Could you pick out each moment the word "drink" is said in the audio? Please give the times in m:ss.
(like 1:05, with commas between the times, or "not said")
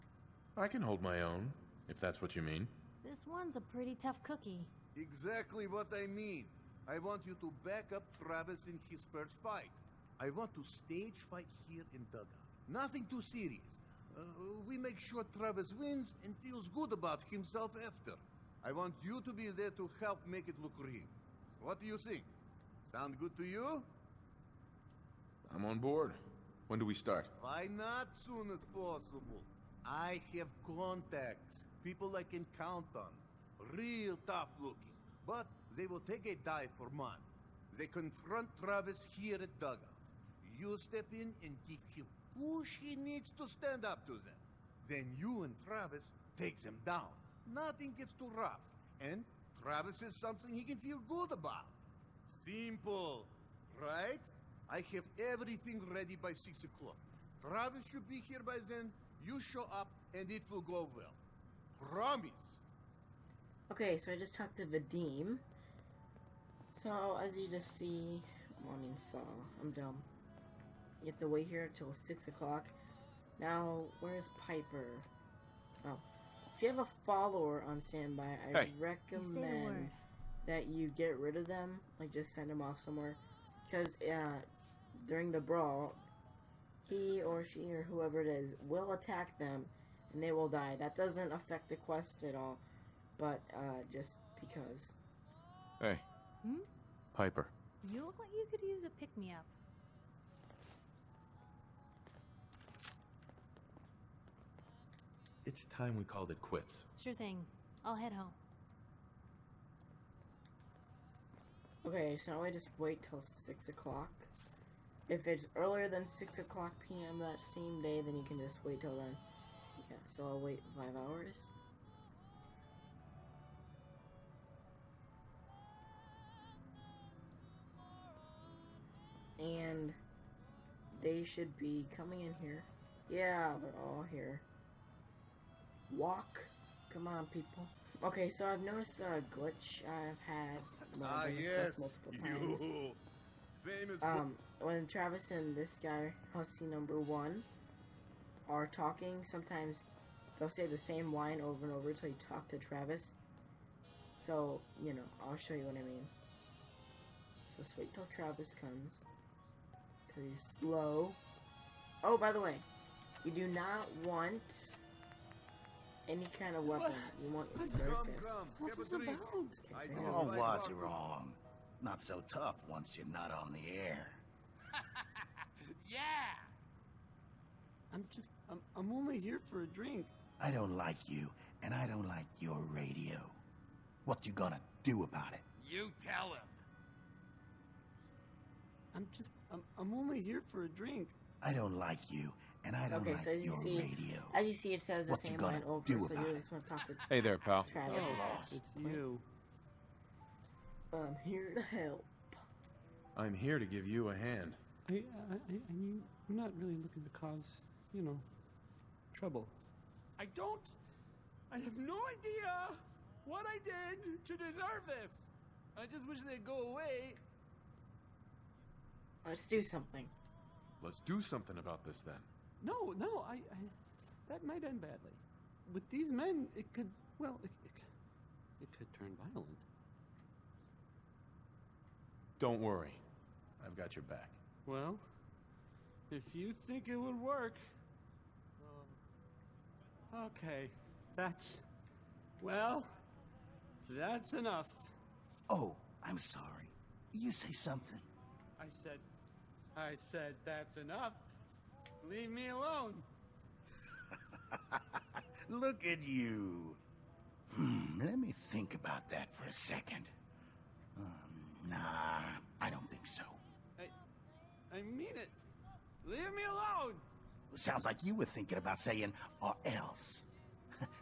2:59, 3:10.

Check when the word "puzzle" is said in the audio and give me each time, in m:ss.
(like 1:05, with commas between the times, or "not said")
not said.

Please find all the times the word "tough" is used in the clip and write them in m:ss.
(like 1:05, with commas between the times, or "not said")
0:03, 0:34, 2:52.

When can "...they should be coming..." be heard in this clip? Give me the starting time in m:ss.
2:11.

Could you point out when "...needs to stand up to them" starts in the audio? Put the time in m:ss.
0:42.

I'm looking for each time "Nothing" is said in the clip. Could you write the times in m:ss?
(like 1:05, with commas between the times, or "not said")
0:12, 0:47.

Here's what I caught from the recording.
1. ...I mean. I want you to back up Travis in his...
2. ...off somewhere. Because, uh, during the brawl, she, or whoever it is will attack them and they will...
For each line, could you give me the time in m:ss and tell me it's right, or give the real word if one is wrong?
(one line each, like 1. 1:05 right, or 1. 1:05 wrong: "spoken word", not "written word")
1. 0:05 right
2. 1:22 right.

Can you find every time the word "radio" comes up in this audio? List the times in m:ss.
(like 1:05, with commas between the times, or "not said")
3:02, 3:13.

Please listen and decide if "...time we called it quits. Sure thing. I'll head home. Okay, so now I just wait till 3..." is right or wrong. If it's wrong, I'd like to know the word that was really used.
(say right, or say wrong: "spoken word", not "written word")
wrong: "6", not "3".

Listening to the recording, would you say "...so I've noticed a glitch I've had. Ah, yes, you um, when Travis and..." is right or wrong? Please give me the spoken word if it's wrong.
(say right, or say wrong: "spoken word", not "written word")
right.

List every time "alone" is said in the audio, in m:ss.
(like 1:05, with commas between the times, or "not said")
4:12, 4:26.